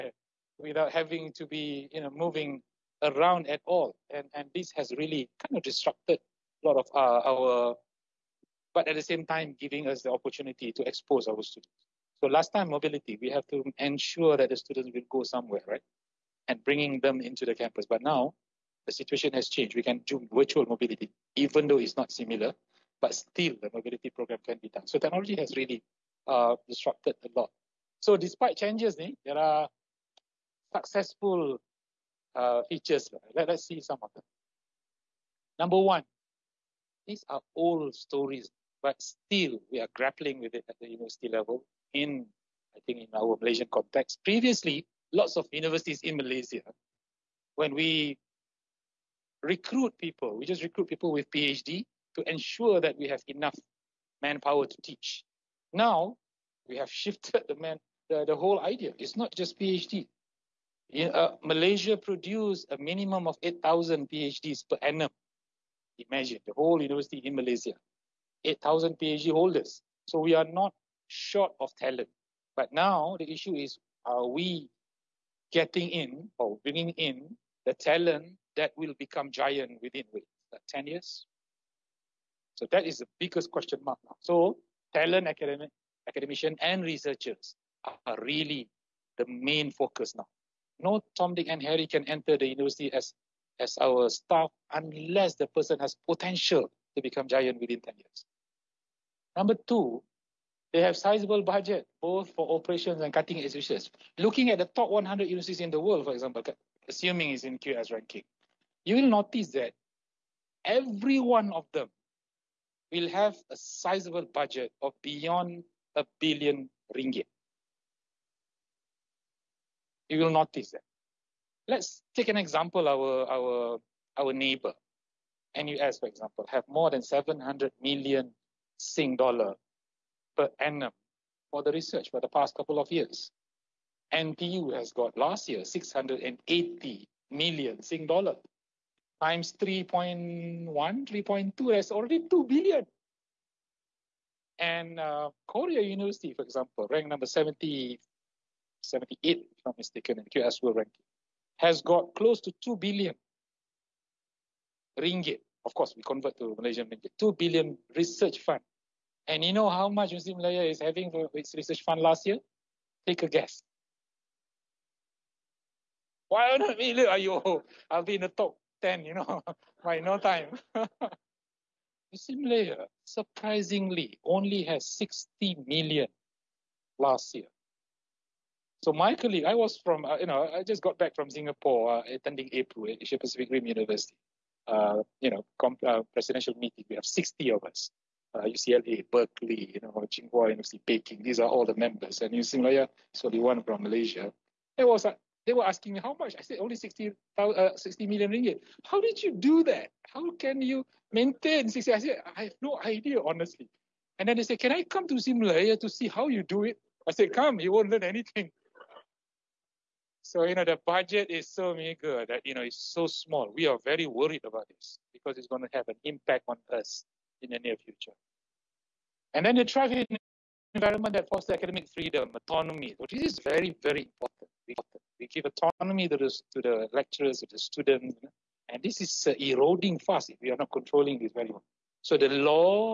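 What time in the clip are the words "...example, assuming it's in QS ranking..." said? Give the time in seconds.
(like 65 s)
106 s.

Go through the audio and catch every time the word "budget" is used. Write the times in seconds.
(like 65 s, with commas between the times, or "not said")
101 s, 114 s, 210 s.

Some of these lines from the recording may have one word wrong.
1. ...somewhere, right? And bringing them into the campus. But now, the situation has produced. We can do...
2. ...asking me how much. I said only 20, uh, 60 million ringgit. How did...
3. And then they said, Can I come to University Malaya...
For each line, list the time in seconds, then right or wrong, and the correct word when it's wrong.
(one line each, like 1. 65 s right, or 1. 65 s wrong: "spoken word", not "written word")
1. 15 s wrong: "changed", not "produced"
2. 195 s wrong: "60", not "20"
3. 204 s right.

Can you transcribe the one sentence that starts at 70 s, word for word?
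So we are not short of talent.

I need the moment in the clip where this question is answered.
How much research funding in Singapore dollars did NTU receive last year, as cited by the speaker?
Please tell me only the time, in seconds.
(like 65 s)
135 s.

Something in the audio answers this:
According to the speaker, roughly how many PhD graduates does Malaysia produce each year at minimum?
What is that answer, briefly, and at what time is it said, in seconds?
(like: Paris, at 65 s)
8,000, at 63 s.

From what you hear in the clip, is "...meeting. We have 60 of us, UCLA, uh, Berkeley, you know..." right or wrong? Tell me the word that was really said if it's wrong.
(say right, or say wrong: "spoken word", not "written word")
right.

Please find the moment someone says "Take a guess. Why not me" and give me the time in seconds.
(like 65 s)
163 s.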